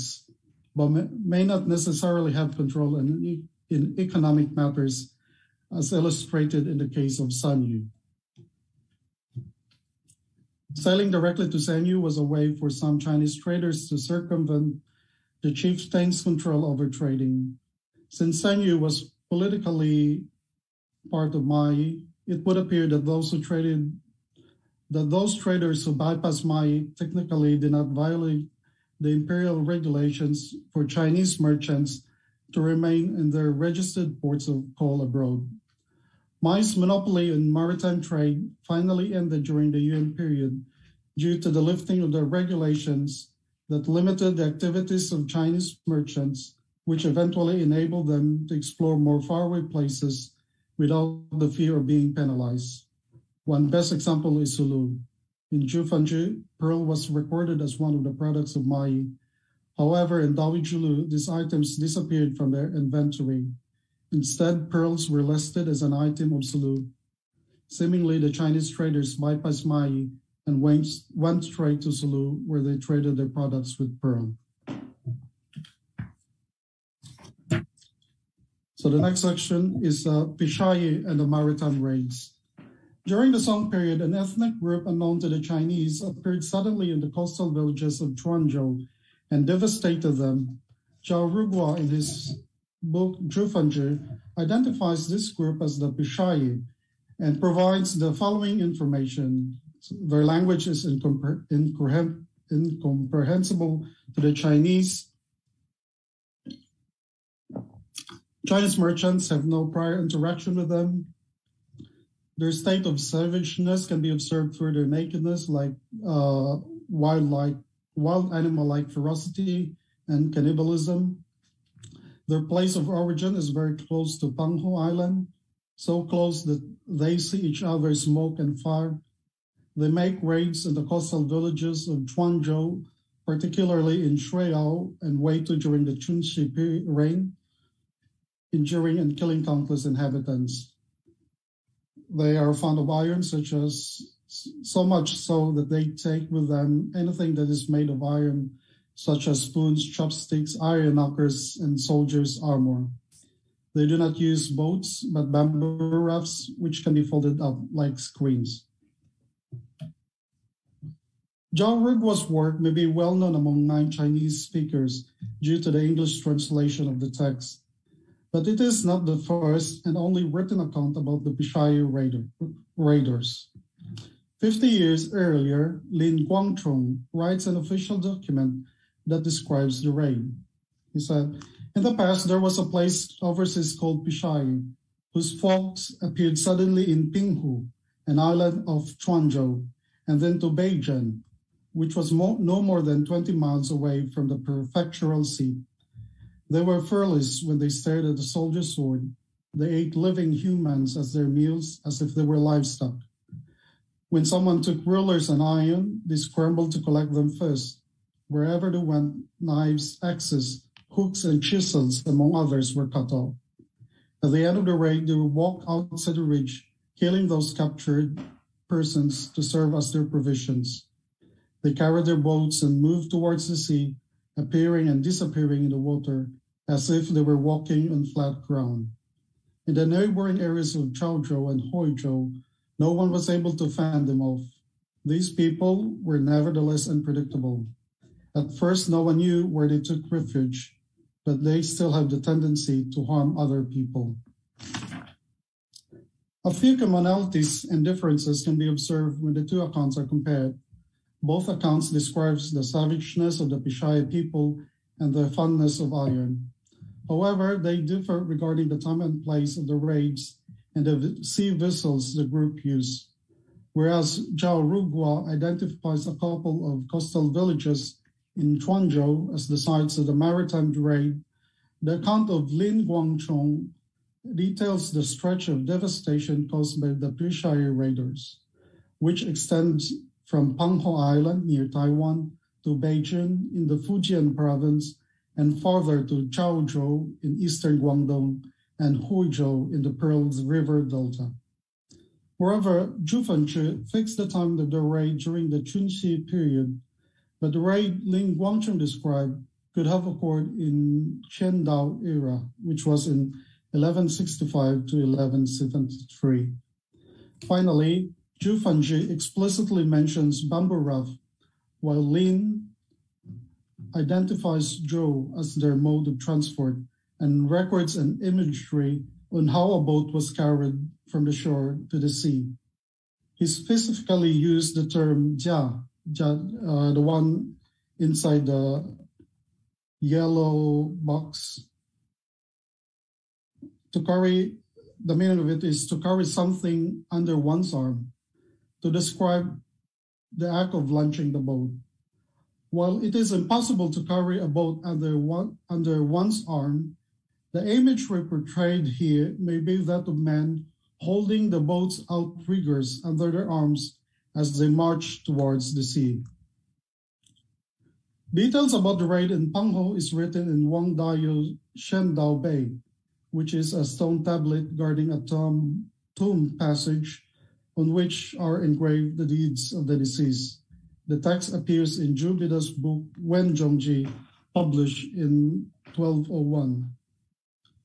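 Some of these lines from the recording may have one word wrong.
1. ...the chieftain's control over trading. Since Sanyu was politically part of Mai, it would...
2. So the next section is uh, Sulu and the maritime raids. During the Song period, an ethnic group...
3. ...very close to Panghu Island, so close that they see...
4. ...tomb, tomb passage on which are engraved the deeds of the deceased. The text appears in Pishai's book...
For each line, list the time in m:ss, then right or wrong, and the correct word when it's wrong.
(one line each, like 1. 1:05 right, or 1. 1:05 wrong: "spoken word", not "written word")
1. 0:15 right
2. 1:18 wrong: "Pishayi", not "Sulu"
3. 2:03 right
4. 6:05 wrong: "Jubida", not "Pishai".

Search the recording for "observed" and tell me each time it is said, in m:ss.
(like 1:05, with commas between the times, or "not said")
1:54, 4:08.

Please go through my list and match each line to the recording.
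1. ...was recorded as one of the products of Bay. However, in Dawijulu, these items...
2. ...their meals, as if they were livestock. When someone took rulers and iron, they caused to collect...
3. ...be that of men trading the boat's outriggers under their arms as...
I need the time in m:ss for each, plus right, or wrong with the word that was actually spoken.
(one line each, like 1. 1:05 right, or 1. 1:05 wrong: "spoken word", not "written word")
1. 0:56 wrong: "Mai", not "Bay"
2. 3:21 wrong: "scrambled", not "caused"
3. 5:49 wrong: "holding", not "trading".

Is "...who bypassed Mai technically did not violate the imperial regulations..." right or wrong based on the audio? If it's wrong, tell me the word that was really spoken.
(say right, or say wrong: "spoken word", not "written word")
right.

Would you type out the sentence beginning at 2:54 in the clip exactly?
Fifty years earlier, Lin Guangchong writes an official document that describes the rain.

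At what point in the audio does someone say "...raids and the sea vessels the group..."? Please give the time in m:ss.
4:19.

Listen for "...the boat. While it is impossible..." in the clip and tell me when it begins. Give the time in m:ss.
5:41.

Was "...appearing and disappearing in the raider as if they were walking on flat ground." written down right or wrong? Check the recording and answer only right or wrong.
wrong.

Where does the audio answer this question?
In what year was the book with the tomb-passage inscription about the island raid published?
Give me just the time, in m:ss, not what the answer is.
6:15.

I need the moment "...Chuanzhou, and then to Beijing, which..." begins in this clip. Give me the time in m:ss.
3:08.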